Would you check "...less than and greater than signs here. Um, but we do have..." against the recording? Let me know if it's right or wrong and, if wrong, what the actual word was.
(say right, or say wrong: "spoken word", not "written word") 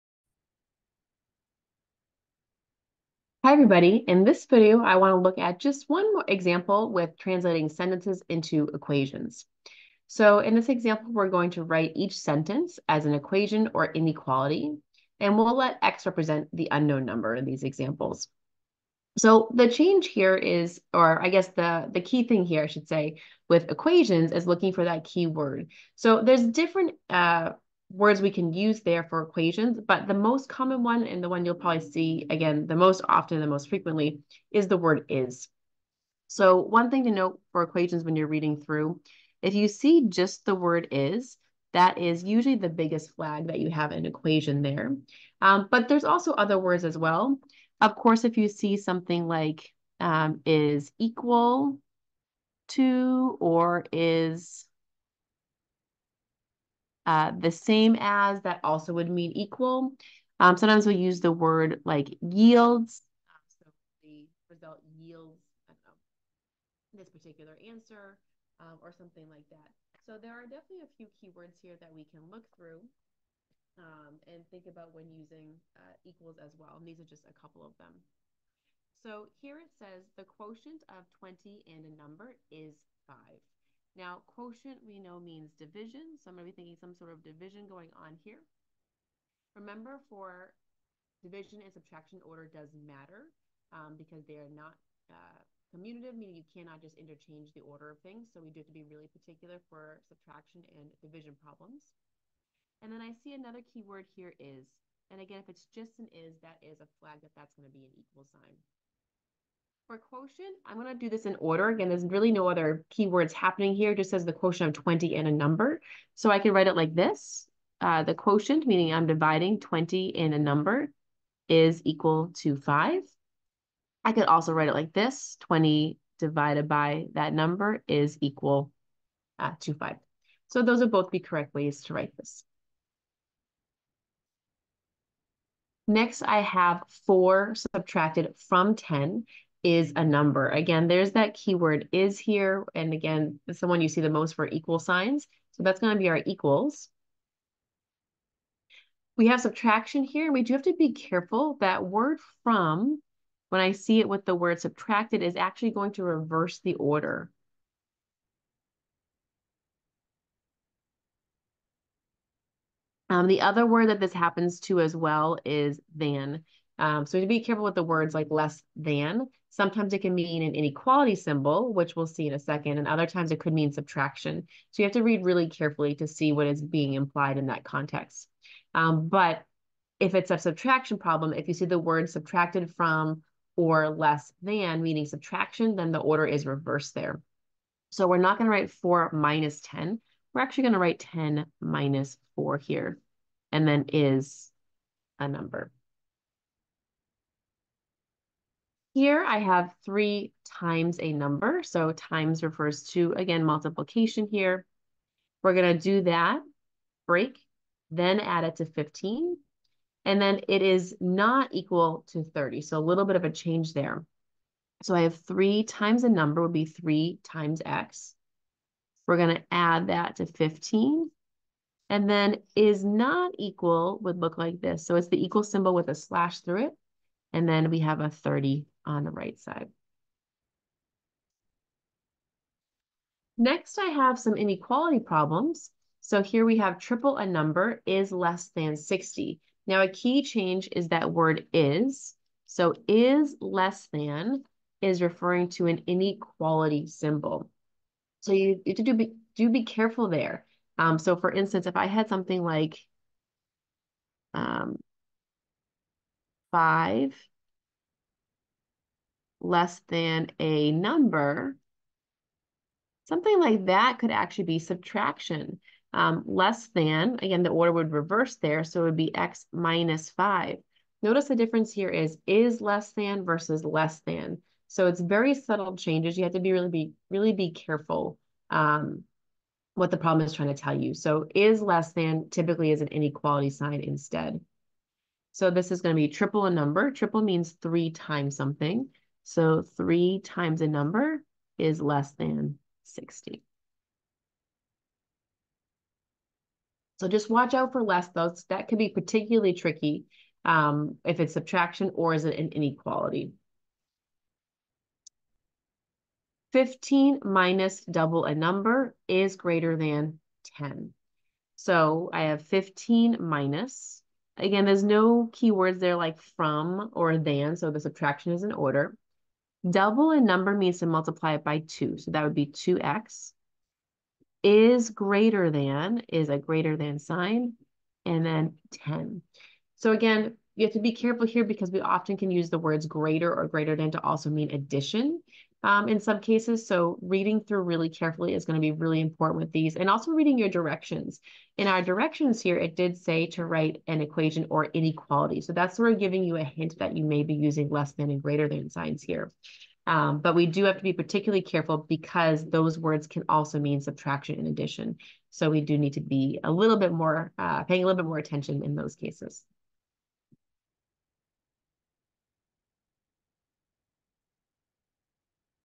right.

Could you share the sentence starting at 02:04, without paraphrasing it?
I could also write it like this.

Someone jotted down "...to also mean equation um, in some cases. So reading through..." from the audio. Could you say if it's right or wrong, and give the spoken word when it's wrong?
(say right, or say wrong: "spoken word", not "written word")
wrong: "addition", not "equation".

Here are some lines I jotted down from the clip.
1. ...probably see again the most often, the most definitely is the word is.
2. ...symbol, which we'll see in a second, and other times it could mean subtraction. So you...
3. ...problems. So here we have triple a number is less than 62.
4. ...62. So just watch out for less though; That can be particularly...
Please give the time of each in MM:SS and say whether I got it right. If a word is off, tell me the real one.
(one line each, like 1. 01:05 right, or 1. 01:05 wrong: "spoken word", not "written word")
1. 00:31 wrong: "frequently", not "definitely"
2. 02:51 right
3. 03:54 wrong: "60", not "62"
4. 04:52 wrong: "60", not "62".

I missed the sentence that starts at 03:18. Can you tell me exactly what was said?
Here I have three times a number.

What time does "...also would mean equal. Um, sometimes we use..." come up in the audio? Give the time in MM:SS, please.
00:58.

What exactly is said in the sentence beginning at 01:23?
Now, quotient we know means division, so I'm going to be thinking some sort of division going on here.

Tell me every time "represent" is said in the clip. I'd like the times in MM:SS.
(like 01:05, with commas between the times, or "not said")
00:16.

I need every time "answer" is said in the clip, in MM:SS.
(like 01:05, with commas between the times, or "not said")
01:07.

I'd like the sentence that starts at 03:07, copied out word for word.
So we're not going to write 4 minus 10.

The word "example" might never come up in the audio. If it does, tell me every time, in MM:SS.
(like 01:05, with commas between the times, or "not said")
00:06, 00:10, 00:17.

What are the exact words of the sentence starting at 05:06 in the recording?
15 minus double a number is greater than 10.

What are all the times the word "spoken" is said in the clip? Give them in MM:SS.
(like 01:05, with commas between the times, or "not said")
not said.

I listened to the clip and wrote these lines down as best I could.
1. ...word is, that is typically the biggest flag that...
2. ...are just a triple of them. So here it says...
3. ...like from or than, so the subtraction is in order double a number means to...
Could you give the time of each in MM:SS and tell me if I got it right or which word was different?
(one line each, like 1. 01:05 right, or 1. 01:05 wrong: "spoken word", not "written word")
1. 00:40 wrong: "usually", not "typically"
2. 01:16 wrong: "couple", not "triple"
3. 05:15 right.